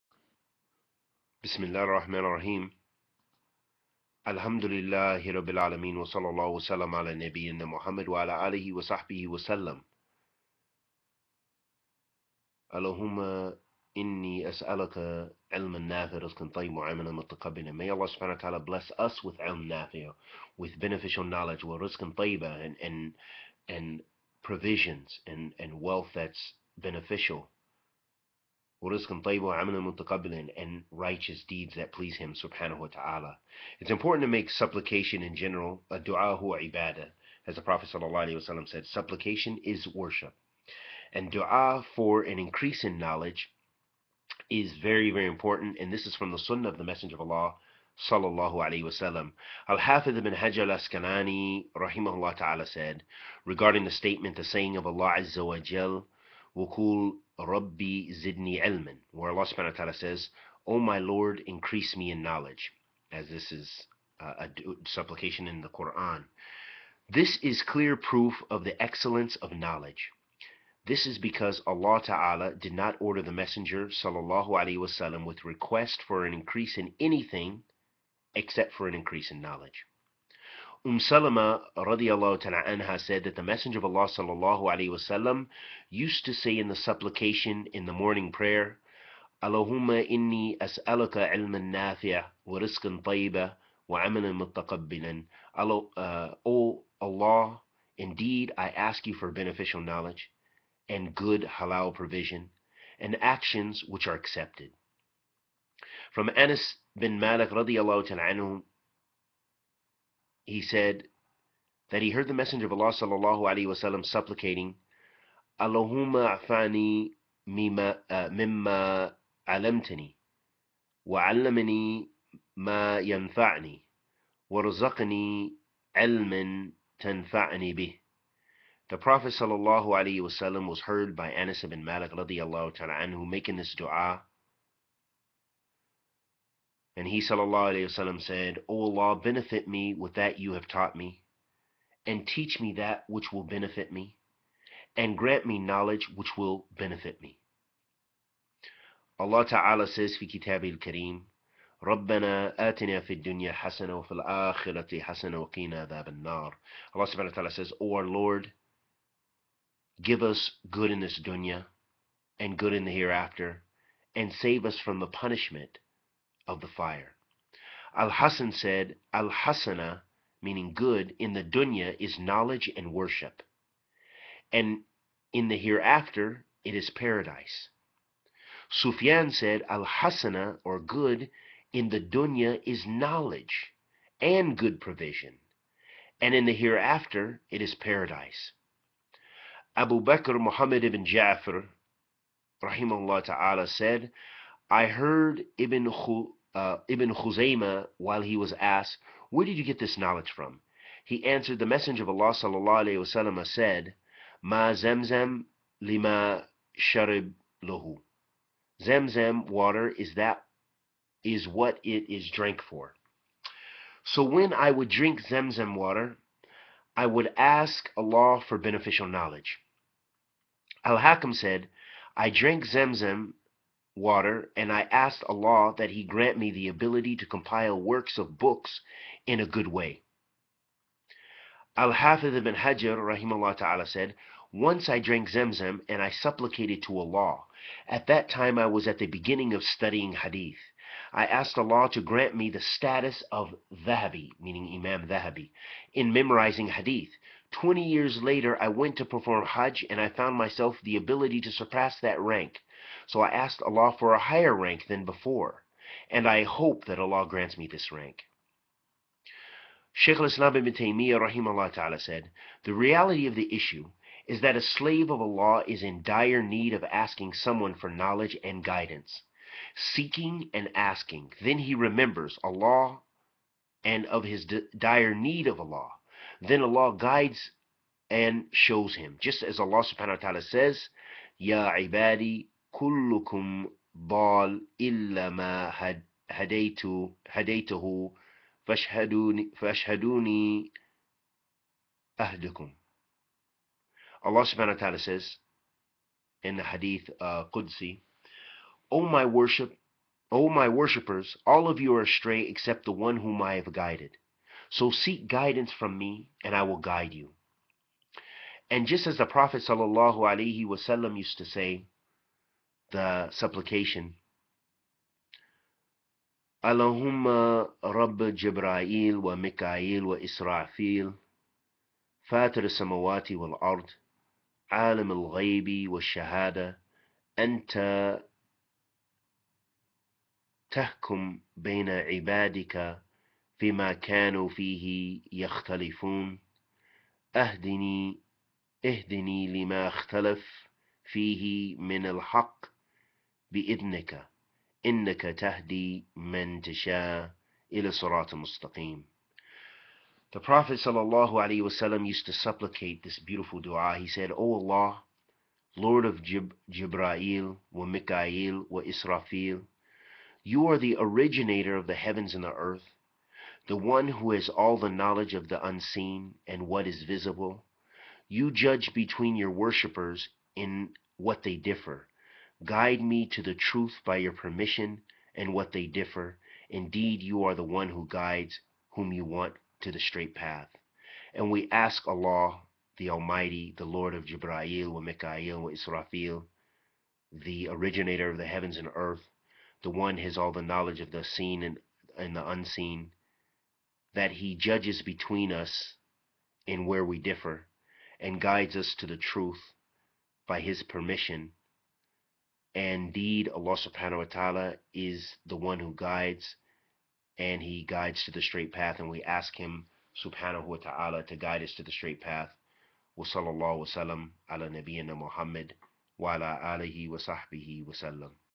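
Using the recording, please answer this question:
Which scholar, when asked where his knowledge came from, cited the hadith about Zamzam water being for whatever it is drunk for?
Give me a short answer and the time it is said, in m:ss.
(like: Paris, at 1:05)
Ibn Khuzaymah, at 3:16.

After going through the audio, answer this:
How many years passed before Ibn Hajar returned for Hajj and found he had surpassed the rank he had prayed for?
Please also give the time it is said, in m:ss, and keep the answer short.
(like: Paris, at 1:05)
20, at 4:07.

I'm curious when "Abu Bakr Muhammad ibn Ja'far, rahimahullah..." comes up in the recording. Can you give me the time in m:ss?
3:09.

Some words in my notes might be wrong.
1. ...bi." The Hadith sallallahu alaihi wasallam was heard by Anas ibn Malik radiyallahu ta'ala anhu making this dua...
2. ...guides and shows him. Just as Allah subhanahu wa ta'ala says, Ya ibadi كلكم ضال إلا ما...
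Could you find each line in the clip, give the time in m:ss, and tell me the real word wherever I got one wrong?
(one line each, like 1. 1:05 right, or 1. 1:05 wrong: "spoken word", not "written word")
1. 2:07 wrong: "Prophet", not "Hadith"
2. 4:36 right.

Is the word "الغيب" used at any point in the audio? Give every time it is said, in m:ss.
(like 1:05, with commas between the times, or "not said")
5:25.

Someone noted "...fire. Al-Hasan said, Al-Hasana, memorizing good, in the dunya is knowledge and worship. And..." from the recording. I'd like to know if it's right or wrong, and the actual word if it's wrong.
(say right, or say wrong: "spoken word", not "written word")
wrong: "meaning", not "memorizing".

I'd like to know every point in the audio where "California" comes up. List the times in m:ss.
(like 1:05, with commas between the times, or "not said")
not said.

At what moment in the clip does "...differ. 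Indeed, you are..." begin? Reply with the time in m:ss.
6:15.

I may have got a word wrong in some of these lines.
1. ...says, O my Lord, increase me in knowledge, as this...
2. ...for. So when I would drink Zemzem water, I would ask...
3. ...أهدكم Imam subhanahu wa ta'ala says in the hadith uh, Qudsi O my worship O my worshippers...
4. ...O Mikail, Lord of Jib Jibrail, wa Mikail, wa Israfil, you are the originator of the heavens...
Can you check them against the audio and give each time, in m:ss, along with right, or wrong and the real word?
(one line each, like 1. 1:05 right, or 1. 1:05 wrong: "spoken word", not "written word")
1. 0:59 right
2. 3:32 right
3. 4:52 wrong: "Allah", not "Imam"
4. 5:54 wrong: "Allah", not "Mikail".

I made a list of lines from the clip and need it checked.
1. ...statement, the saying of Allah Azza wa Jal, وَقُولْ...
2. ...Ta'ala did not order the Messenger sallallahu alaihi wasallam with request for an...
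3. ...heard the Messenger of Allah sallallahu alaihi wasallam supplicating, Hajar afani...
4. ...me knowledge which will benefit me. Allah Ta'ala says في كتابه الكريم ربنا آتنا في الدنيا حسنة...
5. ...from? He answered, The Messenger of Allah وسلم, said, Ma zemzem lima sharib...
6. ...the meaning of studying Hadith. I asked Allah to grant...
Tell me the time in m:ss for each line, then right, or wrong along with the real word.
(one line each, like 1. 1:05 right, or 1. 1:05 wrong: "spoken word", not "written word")
1. 0:53 right
2. 1:12 right
3. 1:52 wrong: "Allahumma", not "Hajar"
4. 2:25 right
5. 3:20 right
6. 3:58 wrong: "beginning", not "meaning".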